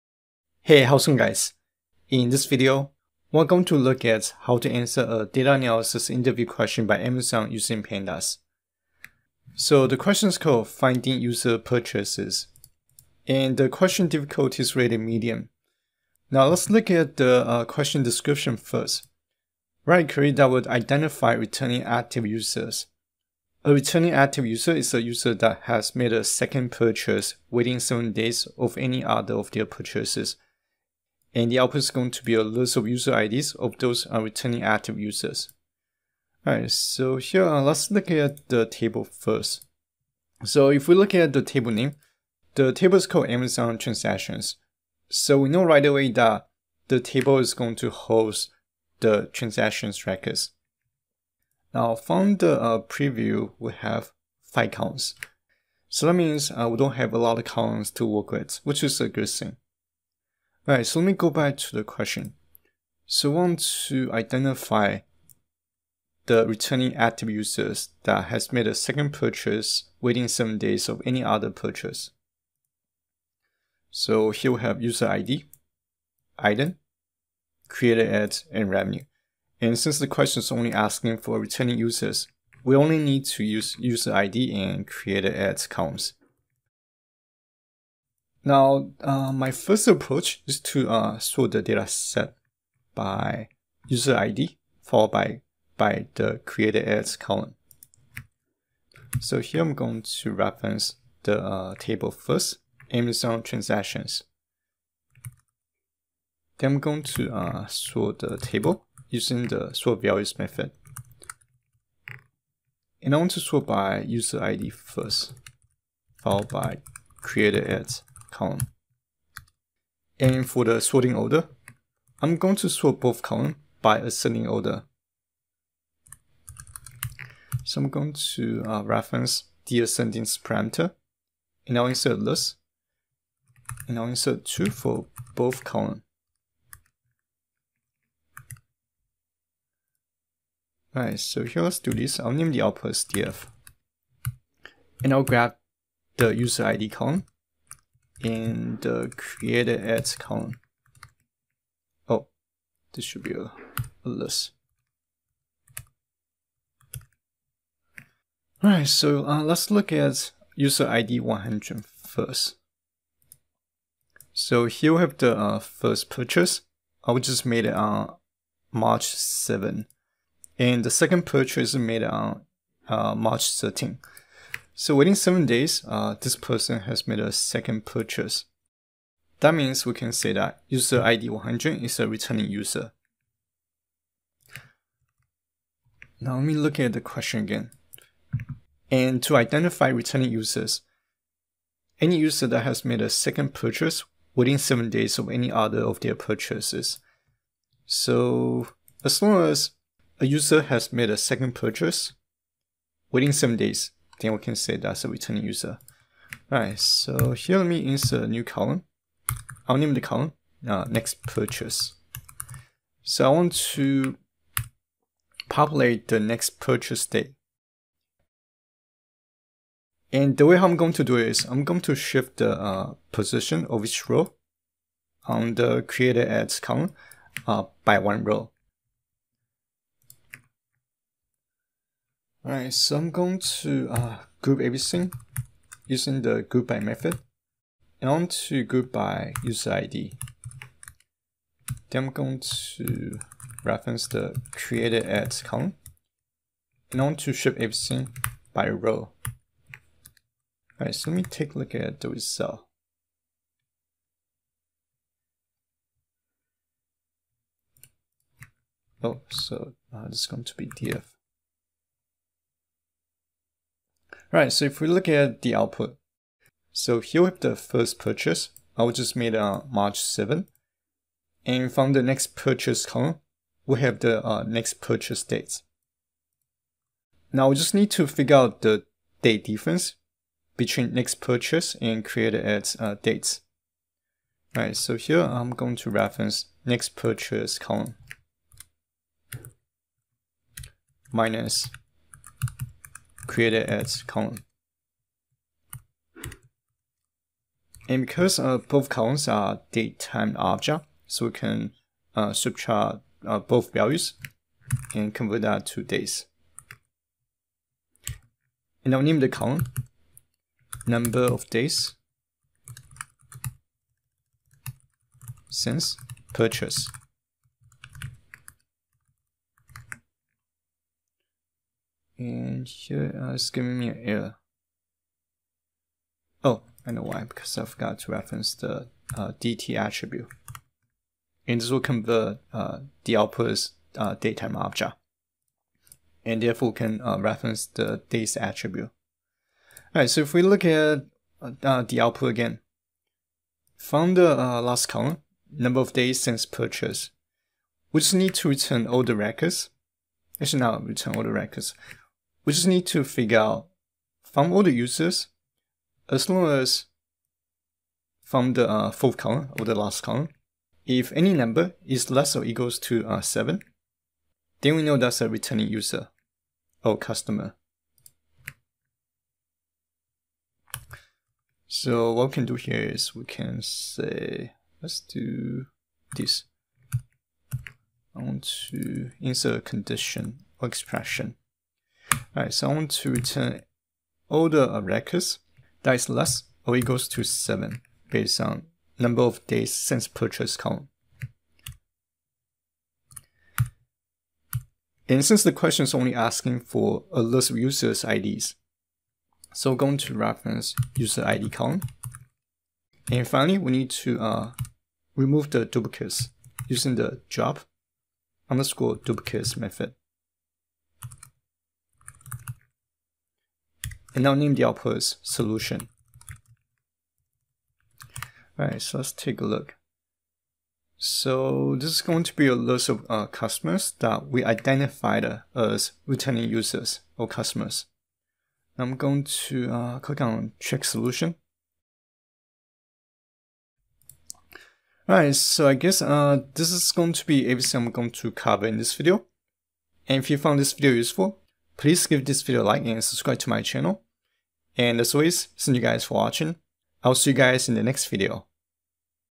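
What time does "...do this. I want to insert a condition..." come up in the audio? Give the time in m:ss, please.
6:15.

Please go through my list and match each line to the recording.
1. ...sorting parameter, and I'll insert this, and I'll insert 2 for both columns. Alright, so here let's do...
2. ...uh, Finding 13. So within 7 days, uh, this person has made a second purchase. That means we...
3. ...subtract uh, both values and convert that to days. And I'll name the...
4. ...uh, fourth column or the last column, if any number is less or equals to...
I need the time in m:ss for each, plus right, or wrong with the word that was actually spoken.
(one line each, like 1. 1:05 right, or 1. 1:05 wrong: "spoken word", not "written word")
1. 2:09 wrong: "ascending", not "sorting"
2. 2:53 wrong: "March", not "Finding"
3. 5:02 right
4. 5:58 right.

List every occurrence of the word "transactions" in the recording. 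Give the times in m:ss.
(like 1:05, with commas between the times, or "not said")
0:43, 0:49, 1:43.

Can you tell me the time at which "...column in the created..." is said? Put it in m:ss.
2:26.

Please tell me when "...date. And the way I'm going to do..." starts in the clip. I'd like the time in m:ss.
3:37.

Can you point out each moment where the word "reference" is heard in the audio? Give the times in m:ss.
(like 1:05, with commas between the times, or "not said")
1:40, 2:08, 4:03, 4:45, 5:28, 5:37, 6:40.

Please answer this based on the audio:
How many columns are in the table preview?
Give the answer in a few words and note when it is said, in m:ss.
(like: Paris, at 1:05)
5, at 0:54.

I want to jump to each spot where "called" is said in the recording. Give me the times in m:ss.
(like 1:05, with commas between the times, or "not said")
0:10, 0:43.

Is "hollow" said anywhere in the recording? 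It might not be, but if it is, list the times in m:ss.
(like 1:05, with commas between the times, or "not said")
not said.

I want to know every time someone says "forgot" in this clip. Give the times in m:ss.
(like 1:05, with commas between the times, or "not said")
5:27.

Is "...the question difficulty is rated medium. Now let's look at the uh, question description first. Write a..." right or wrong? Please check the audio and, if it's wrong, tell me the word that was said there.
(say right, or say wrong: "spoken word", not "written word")
right.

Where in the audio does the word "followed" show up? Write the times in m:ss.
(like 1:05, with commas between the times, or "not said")
1:34, 1:56.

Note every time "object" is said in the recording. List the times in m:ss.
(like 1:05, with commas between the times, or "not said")
5:00, 5:34.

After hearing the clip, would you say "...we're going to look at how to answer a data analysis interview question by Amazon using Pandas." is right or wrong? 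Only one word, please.
right.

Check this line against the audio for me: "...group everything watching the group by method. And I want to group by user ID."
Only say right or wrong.
wrong.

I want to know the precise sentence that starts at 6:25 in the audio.
That is less or equals to 7 based on number of days since purchase column.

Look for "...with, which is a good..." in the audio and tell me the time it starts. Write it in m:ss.
0:58.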